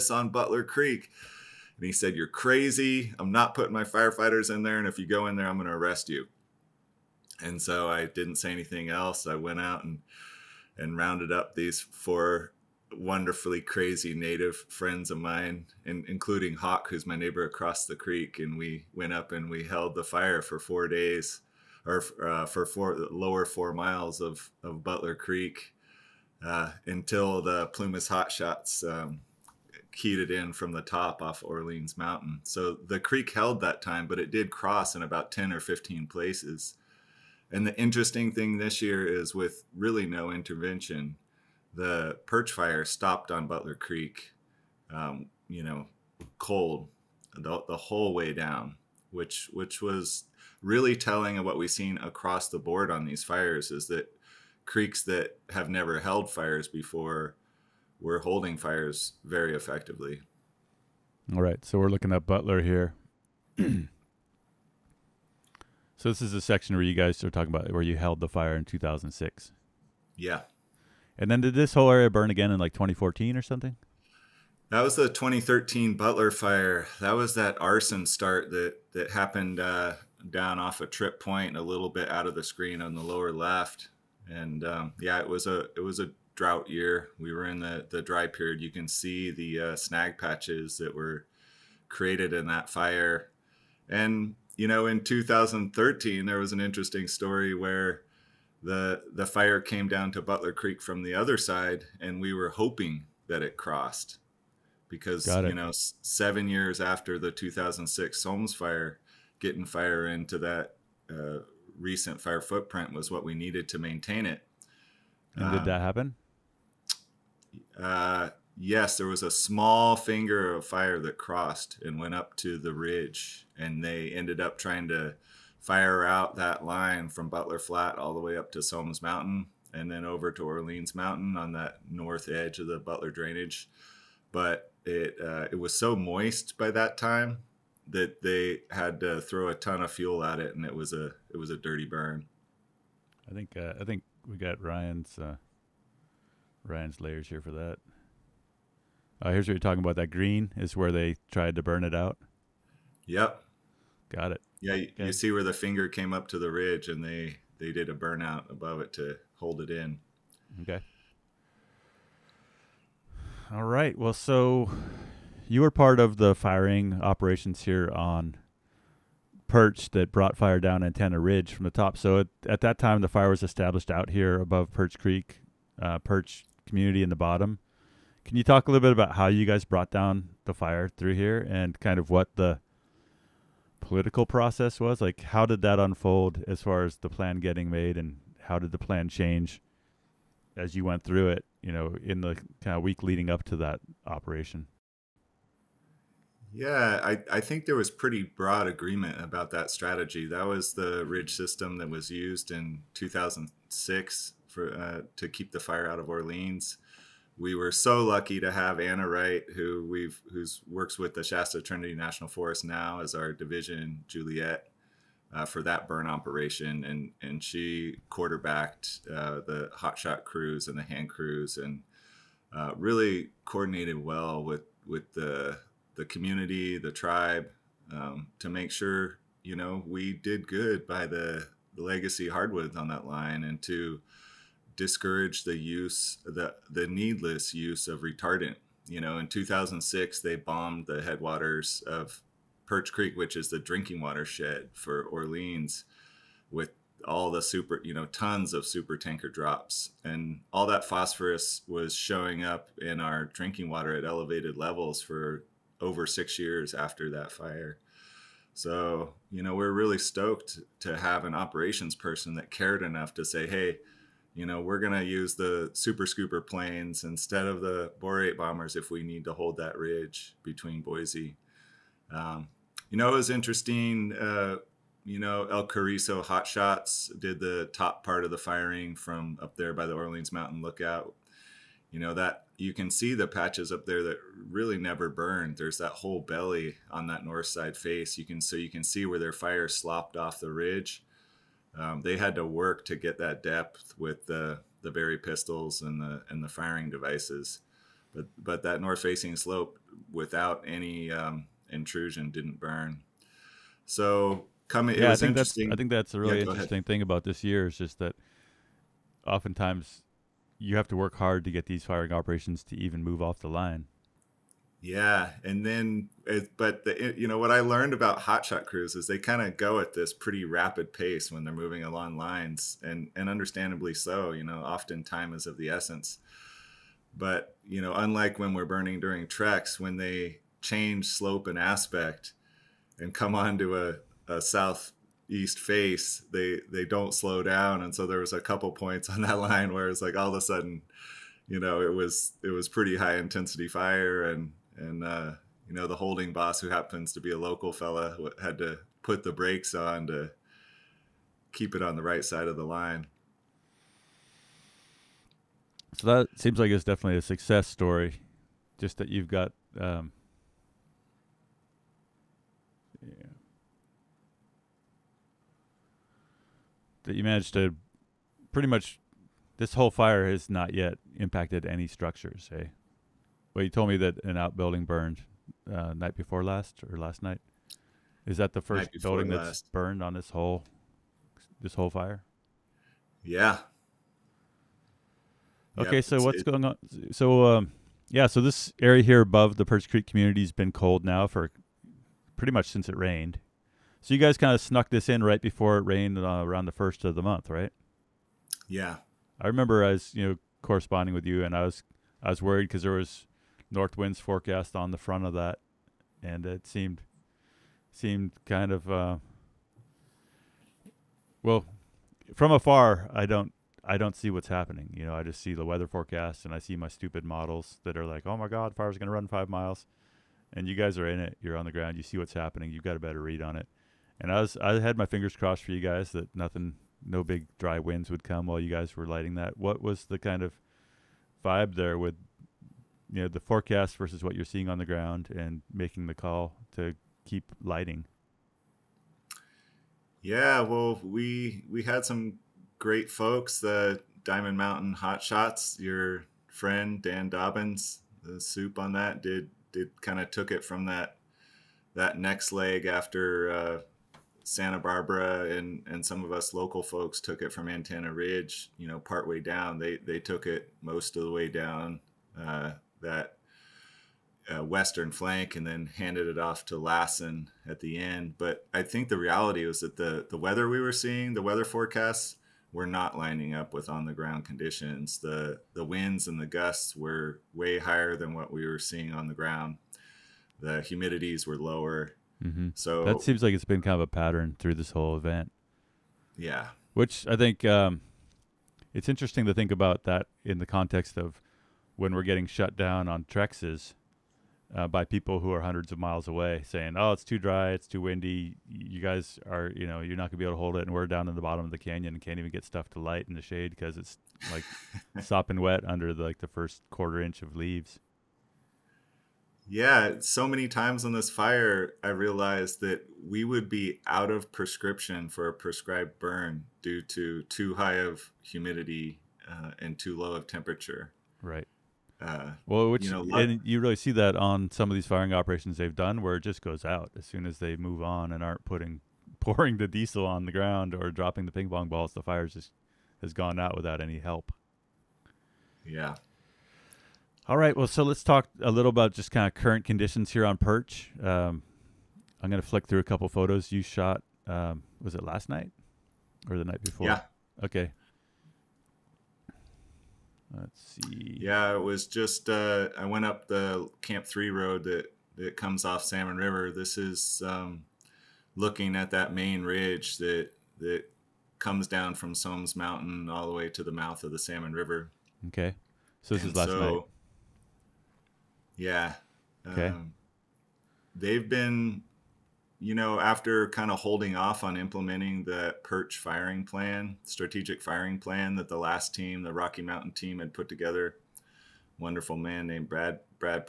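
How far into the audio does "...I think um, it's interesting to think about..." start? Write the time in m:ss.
8:07.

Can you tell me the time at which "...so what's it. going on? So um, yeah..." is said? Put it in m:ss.
6:26.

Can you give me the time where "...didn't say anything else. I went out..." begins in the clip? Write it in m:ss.
0:08.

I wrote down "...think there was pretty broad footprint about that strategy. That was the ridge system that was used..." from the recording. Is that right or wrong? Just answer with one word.
wrong.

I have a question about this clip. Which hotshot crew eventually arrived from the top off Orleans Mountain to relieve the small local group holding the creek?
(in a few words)
Plumas Hotshots.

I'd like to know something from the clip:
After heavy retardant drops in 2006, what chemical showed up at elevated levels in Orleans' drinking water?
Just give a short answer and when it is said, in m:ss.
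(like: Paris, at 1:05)
Phosphorus, at 4:10.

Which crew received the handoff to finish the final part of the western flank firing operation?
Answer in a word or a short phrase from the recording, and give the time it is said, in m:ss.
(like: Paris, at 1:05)
Lassen, at 7:46.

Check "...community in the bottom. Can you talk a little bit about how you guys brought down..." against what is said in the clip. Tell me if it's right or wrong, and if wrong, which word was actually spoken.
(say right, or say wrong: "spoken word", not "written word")
right.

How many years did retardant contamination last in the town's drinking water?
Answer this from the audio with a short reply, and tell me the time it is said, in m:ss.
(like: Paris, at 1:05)
6 years, at 4:16.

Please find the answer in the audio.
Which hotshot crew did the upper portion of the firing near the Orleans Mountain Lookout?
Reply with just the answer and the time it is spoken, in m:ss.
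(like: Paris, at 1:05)
El Cariso Hotshots, at 4:35.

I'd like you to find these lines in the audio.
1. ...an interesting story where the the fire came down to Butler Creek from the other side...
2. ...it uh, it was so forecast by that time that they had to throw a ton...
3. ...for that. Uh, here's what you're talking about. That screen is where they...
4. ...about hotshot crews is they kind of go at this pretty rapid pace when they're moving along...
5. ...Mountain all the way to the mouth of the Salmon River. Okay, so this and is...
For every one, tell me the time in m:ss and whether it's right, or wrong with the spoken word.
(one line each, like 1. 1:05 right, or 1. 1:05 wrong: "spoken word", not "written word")
1. 1:36 right
2. 2:14 wrong: "moist", not "forecast"
3. 2:27 wrong: "green", not "screen"
4. 5:17 right
5. 9:22 right.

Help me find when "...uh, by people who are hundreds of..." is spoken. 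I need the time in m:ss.
8:14.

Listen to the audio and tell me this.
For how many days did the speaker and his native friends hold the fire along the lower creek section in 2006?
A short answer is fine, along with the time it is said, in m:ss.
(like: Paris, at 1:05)
4, at 0:20.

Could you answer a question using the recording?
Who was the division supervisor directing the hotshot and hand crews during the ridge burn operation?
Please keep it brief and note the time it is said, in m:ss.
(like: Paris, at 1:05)
Anna Wright, at 3:28.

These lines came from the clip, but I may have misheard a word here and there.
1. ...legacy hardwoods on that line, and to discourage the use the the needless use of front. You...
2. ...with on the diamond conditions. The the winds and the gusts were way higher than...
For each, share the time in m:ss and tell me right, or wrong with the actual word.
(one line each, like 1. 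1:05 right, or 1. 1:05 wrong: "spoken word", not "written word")
1. 3:51 wrong: "retardant", not "front"
2. 7:53 wrong: "ground", not "diamond".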